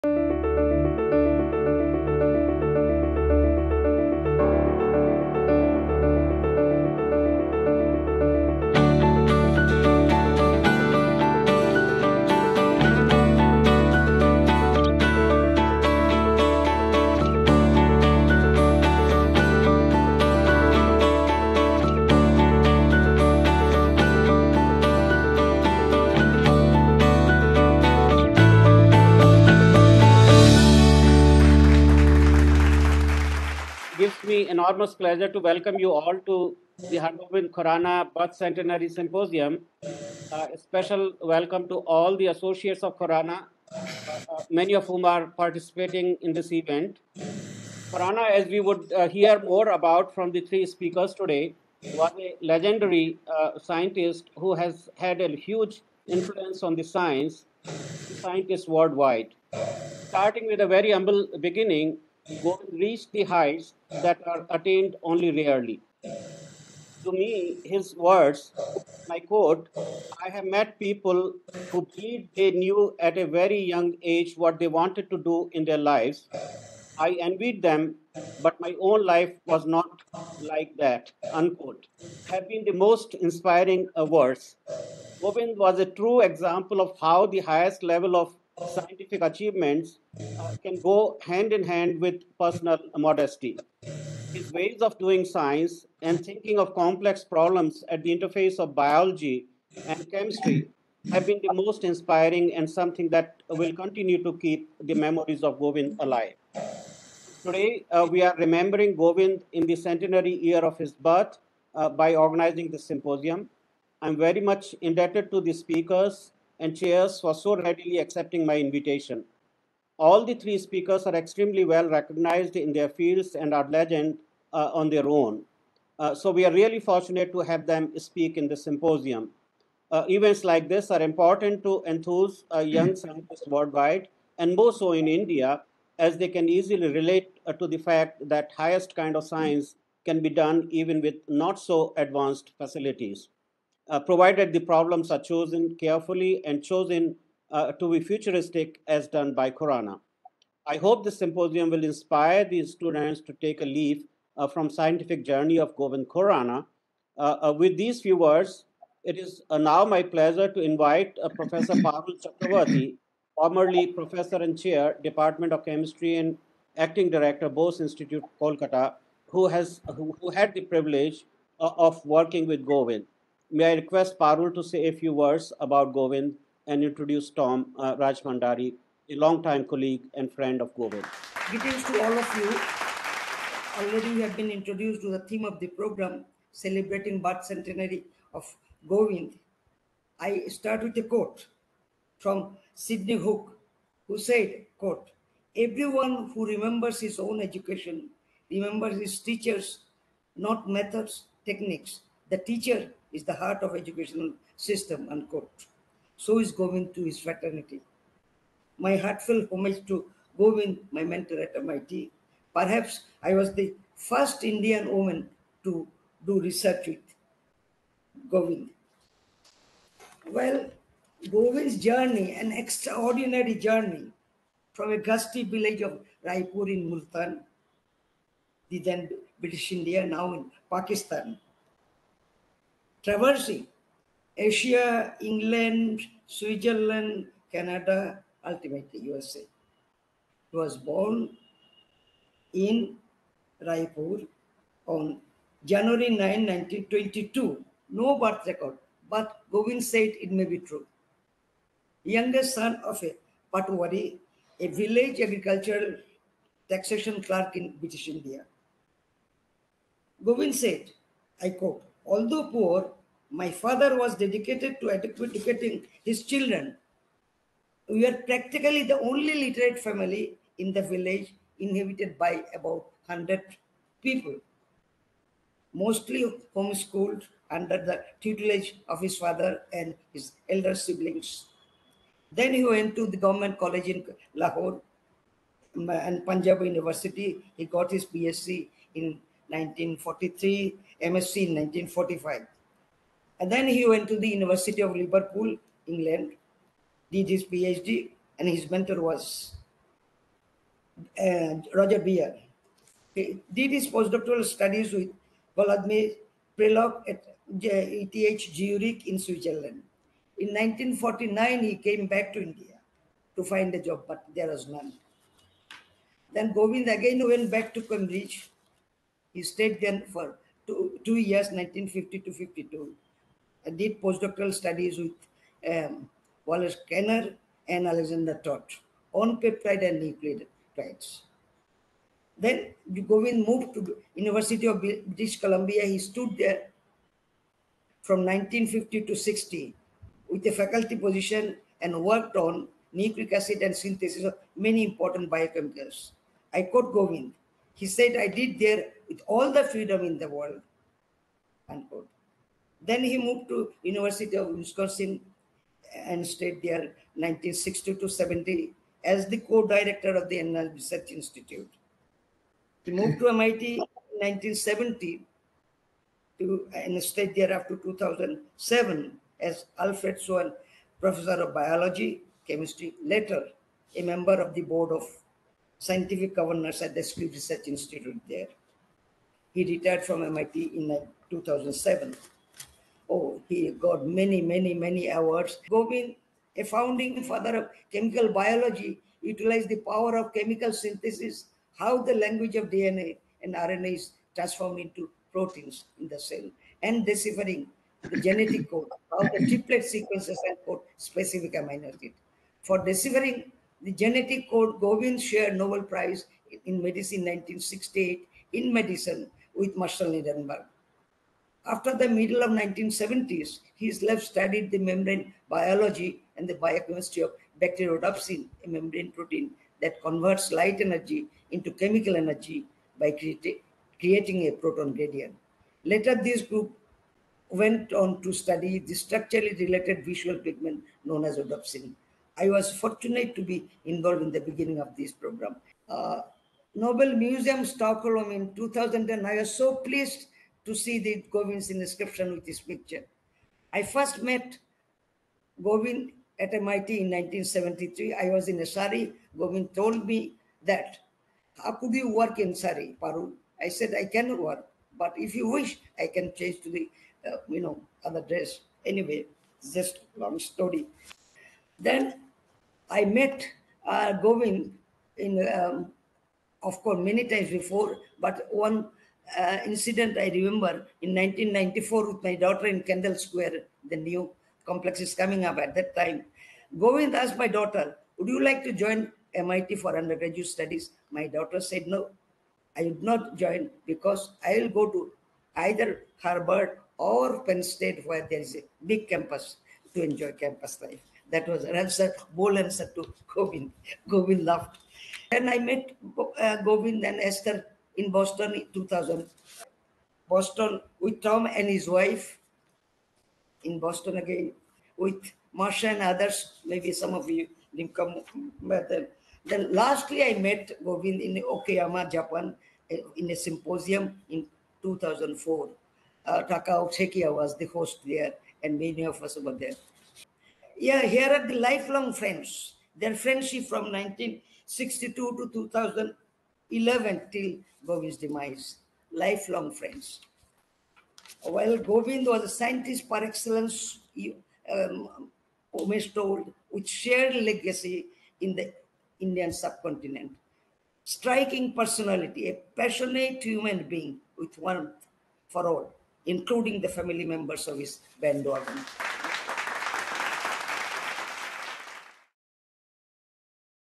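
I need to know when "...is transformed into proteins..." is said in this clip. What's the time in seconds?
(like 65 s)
393 s.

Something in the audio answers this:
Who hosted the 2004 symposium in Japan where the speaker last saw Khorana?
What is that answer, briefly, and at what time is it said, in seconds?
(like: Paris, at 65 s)
Takao Sekiya, at 516 s.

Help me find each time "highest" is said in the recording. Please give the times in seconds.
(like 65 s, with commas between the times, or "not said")
87 s, 138 s.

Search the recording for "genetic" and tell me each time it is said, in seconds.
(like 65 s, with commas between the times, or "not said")
398 s, 403 s.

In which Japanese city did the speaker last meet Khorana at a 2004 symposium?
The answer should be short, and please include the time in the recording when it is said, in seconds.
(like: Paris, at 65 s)
Okayama, at 511 s.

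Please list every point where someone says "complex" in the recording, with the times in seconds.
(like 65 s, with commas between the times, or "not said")
96 s, 474 s.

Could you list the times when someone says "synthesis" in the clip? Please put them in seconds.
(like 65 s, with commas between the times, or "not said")
343 s, 390 s.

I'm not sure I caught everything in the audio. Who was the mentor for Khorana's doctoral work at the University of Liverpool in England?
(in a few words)
Roger Beer.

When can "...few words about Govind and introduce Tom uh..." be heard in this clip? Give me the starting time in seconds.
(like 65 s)
174 s.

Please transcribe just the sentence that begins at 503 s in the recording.
In Boston again with Marsha and others.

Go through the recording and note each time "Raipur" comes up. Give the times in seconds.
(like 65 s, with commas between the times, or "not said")
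226 s, 243 s.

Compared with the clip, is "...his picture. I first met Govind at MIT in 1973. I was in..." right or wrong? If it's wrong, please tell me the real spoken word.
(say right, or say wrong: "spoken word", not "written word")
right.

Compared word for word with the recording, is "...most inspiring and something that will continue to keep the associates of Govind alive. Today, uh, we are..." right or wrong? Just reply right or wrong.
wrong.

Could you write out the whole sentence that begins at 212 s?
Perhaps I was the first Indian woman to do research with Govind.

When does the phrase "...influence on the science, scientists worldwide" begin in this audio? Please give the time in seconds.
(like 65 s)
56 s.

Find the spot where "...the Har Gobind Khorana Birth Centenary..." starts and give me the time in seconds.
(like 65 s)
36 s.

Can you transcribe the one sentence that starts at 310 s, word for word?
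In 1949, he came back to India to find a job, but there was none.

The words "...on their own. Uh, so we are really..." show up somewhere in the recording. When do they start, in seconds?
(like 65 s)
124 s.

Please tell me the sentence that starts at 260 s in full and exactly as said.
Govind said, I quote, Although poor, my father was dedicated to educating his children.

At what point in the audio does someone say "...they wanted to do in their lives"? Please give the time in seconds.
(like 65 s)
74 s.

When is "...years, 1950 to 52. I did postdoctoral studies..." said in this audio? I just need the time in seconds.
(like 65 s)
321 s.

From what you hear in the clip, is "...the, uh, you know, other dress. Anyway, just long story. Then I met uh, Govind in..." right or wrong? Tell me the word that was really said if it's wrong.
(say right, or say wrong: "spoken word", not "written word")
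right.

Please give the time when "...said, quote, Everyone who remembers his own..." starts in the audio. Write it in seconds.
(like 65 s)
194 s.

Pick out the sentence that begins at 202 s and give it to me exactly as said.
The teacher is the heart of educational system, unquote.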